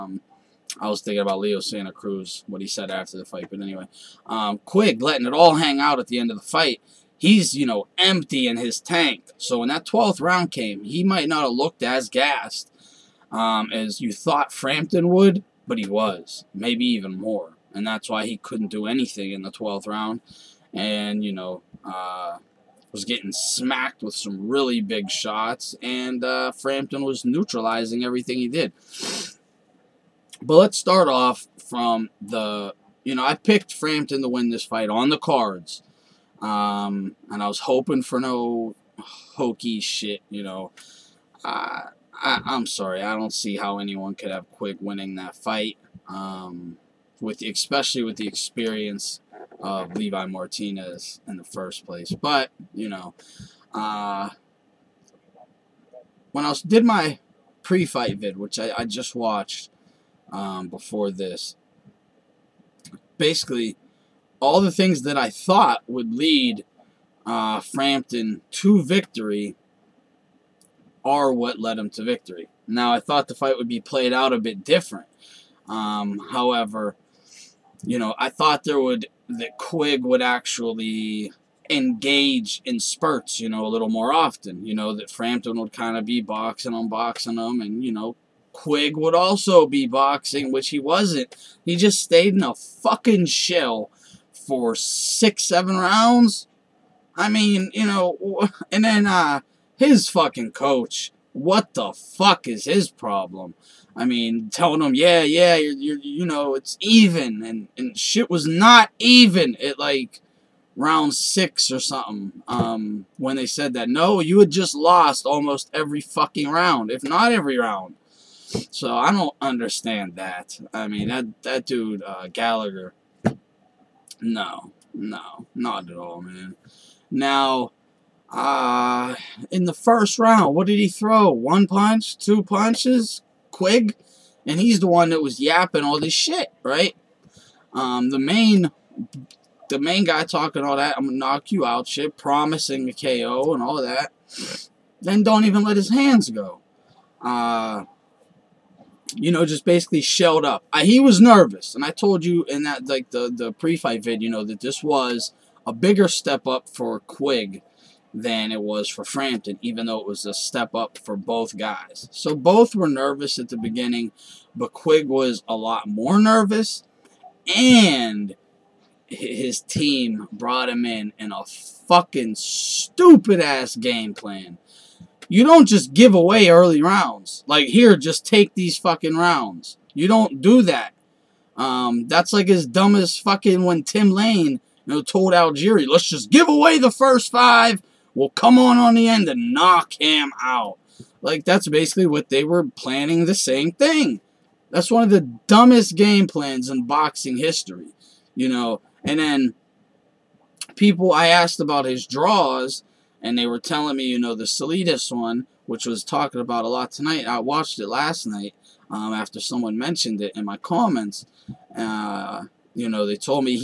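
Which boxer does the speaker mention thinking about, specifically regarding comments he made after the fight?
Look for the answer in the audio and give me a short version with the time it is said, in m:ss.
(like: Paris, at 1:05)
Leo Santa Cruz, at 0:01.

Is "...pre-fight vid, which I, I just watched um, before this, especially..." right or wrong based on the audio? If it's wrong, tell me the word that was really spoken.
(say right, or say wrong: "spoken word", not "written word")
wrong: "basically", not "especially".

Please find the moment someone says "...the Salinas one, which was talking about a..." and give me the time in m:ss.
3:24.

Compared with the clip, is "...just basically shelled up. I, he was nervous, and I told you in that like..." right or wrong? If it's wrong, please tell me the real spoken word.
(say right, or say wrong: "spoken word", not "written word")
right.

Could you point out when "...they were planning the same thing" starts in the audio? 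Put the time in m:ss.
3:12.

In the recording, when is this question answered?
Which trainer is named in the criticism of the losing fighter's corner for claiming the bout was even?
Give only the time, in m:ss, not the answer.
2:02.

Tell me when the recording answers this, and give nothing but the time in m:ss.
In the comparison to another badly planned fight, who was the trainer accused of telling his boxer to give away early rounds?
3:03.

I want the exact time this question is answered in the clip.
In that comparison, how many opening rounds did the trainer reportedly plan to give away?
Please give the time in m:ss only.
3:06.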